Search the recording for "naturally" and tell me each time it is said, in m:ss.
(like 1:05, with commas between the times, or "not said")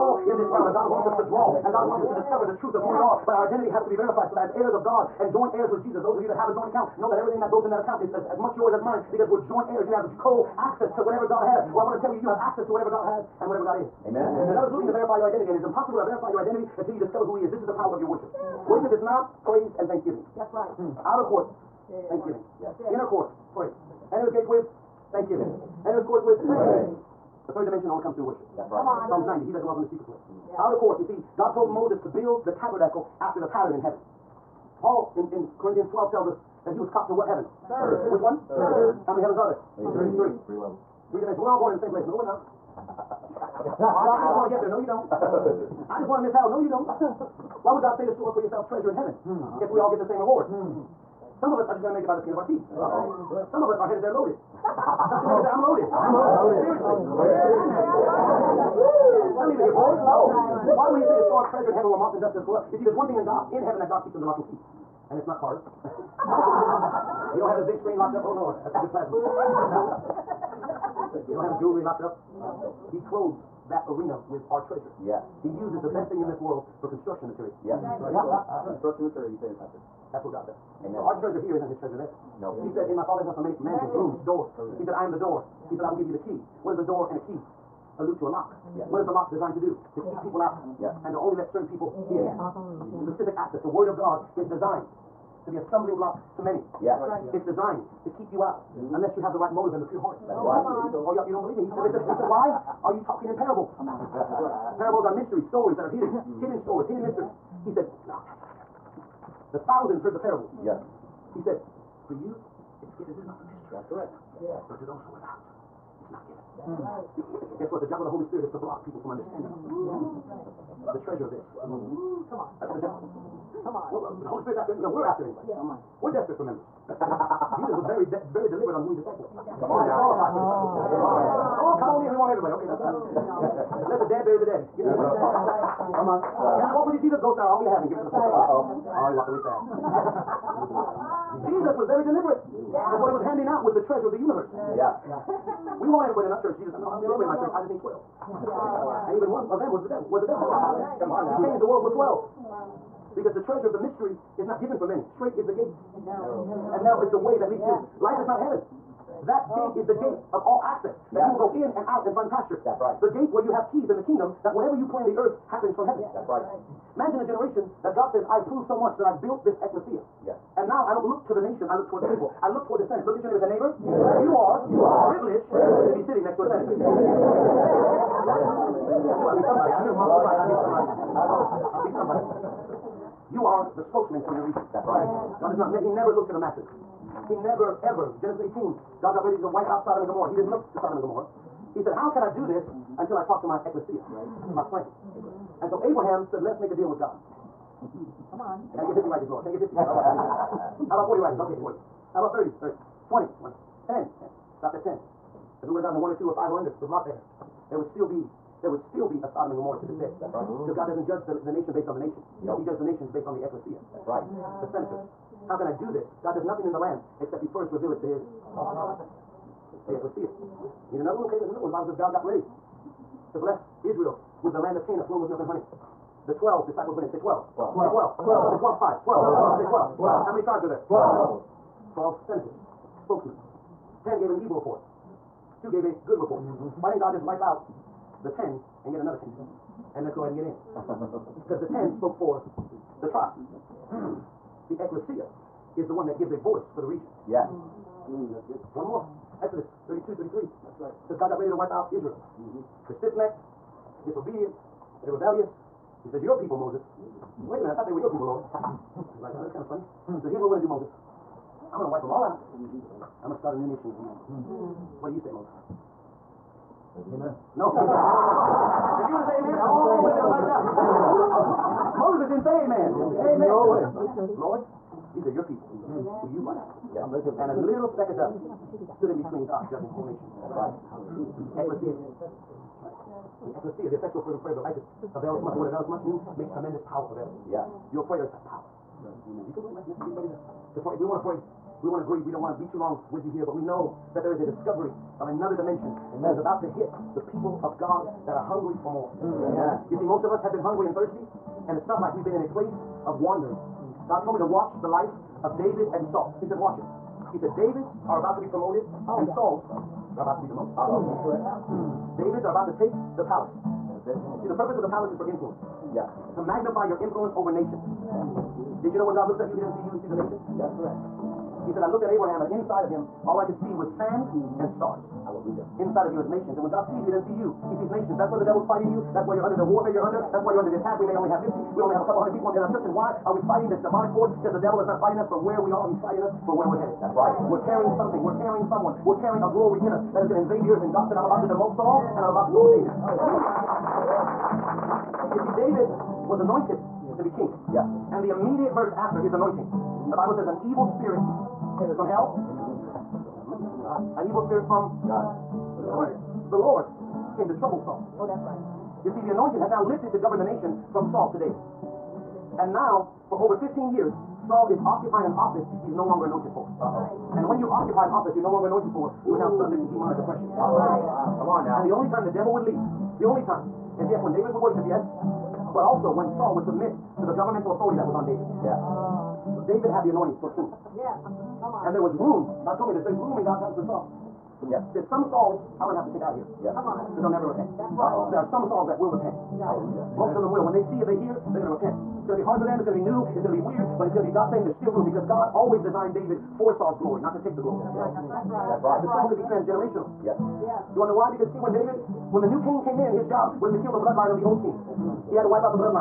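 0:57.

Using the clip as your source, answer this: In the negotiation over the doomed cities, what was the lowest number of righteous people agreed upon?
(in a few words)
10.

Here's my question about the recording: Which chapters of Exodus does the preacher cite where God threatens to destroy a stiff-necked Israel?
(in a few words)
32 and 33.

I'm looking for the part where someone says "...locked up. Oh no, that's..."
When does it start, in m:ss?
1:07.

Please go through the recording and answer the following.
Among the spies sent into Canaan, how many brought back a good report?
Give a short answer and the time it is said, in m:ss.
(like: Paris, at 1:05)
2, at 3:55.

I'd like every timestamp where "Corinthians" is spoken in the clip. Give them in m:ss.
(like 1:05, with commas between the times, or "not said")
0:35.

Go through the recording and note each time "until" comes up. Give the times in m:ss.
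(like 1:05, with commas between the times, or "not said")
0:16, 3:12.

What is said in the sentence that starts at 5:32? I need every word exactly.
And why are we fighting this demonic force?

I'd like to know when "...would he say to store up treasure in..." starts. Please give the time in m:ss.
1:00.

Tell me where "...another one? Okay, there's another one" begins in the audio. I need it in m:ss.
3:40.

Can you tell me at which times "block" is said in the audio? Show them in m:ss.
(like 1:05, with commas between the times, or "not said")
1:35, 1:58.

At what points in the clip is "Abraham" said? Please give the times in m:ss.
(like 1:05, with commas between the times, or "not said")
3:15, 5:22.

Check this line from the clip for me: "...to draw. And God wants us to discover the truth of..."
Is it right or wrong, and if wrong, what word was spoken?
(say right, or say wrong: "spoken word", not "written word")
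right.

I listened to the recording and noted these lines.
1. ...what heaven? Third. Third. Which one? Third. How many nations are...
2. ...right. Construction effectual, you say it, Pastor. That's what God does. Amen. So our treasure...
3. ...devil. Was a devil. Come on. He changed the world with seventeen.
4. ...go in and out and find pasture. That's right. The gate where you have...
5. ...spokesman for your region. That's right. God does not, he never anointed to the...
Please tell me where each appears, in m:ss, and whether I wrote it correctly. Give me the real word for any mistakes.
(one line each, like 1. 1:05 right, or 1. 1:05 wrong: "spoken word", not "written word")
1. 0:37 wrong: "heavens", not "nations"
2. 1:17 wrong: "material", not "effectual"
3. 2:29 wrong: "twelve", not "seventeen"
4. 2:41 right
5. 3:03 wrong: "looked", not "anointed".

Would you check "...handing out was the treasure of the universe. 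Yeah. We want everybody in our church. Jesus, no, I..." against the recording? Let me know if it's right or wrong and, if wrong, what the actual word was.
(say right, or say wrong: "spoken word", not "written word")
right.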